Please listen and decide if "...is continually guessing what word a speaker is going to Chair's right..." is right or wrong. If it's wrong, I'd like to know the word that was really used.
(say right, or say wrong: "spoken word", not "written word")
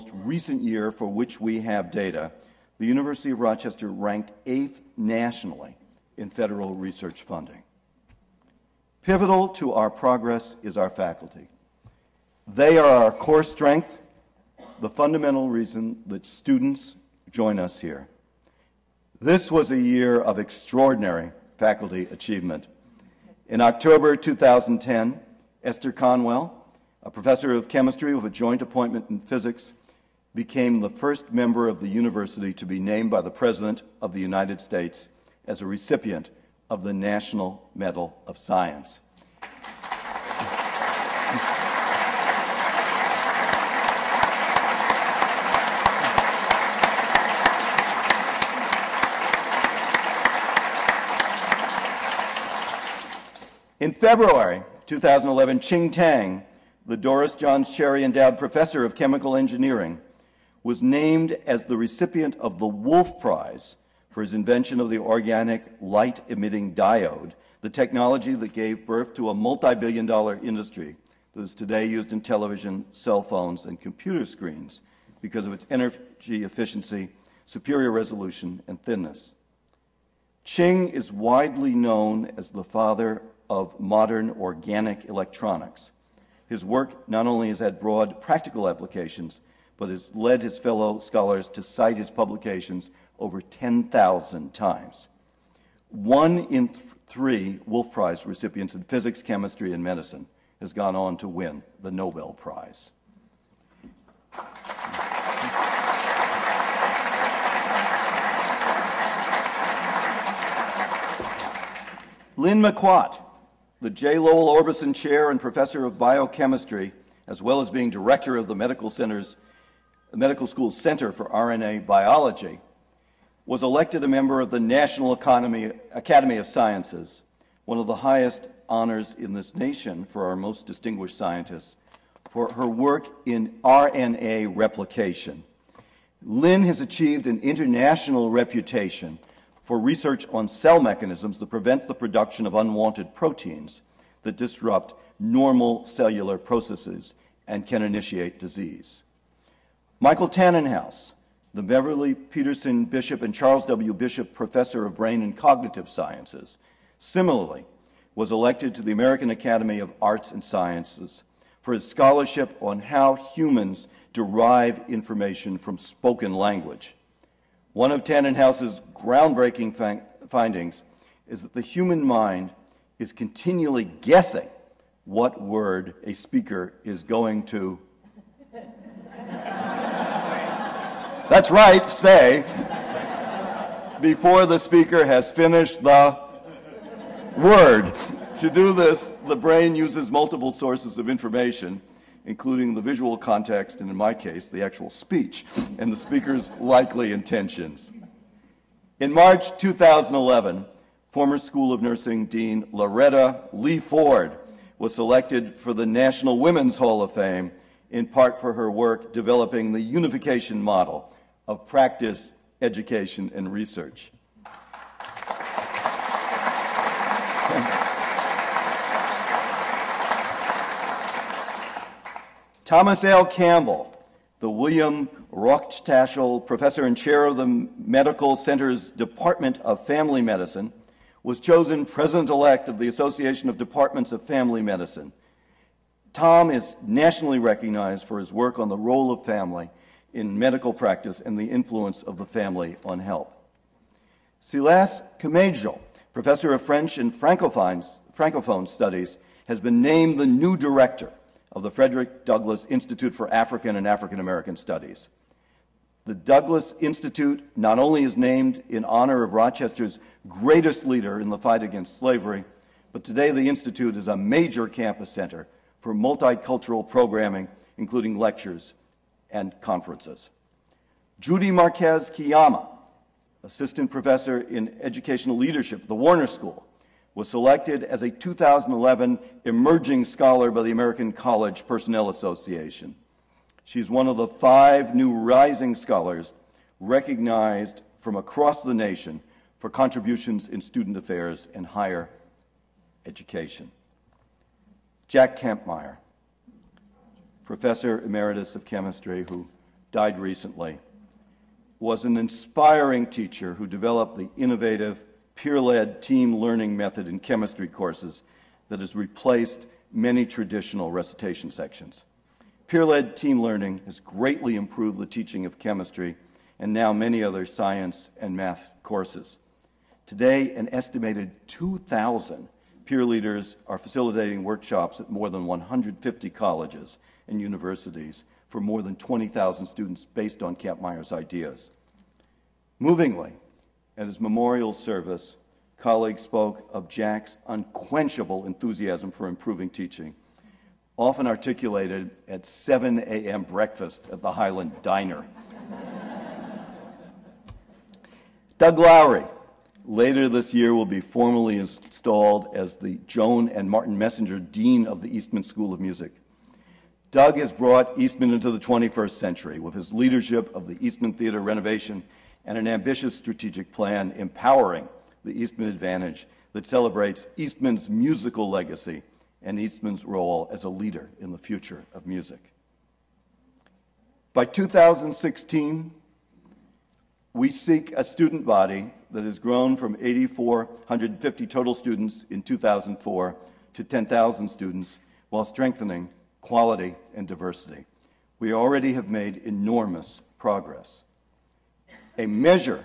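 wrong: "That", not "Chair".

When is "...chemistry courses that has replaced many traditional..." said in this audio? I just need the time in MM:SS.
05:07.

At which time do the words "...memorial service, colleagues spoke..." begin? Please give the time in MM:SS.
05:34.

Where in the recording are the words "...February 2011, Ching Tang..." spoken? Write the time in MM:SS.
00:53.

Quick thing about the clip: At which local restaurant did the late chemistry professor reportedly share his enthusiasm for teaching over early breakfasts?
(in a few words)
Highland Diner.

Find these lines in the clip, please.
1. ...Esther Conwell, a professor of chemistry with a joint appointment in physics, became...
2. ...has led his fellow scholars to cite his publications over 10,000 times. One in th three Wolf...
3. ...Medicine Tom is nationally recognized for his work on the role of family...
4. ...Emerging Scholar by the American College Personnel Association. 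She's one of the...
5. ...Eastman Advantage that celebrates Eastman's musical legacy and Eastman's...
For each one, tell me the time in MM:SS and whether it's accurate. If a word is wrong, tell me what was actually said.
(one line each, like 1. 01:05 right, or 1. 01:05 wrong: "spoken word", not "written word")
1. 00:25 right
2. 01:29 right
3. 03:54 right
4. 04:39 right
5. 06:05 right.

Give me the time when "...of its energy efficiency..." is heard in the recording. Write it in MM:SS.
01:15.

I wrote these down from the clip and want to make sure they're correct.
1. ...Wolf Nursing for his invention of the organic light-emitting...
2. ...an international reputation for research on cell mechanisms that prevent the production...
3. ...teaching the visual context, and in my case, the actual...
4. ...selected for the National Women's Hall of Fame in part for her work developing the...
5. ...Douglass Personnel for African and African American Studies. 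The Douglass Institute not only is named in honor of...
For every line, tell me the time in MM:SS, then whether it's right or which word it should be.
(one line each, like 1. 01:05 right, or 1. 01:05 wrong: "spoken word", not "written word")
1. 01:02 wrong: "Prize", not "Nursing"
2. 02:17 right
3. 03:12 wrong: "including", not "teaching"
4. 03:24 right
5. 04:12 wrong: "Institute", not "Personnel".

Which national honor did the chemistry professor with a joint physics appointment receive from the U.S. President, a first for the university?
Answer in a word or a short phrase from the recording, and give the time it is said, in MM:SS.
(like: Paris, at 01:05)
National Medal of Science, at 00:36.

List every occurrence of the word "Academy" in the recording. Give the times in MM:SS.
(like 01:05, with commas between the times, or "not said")
02:05, 02:39.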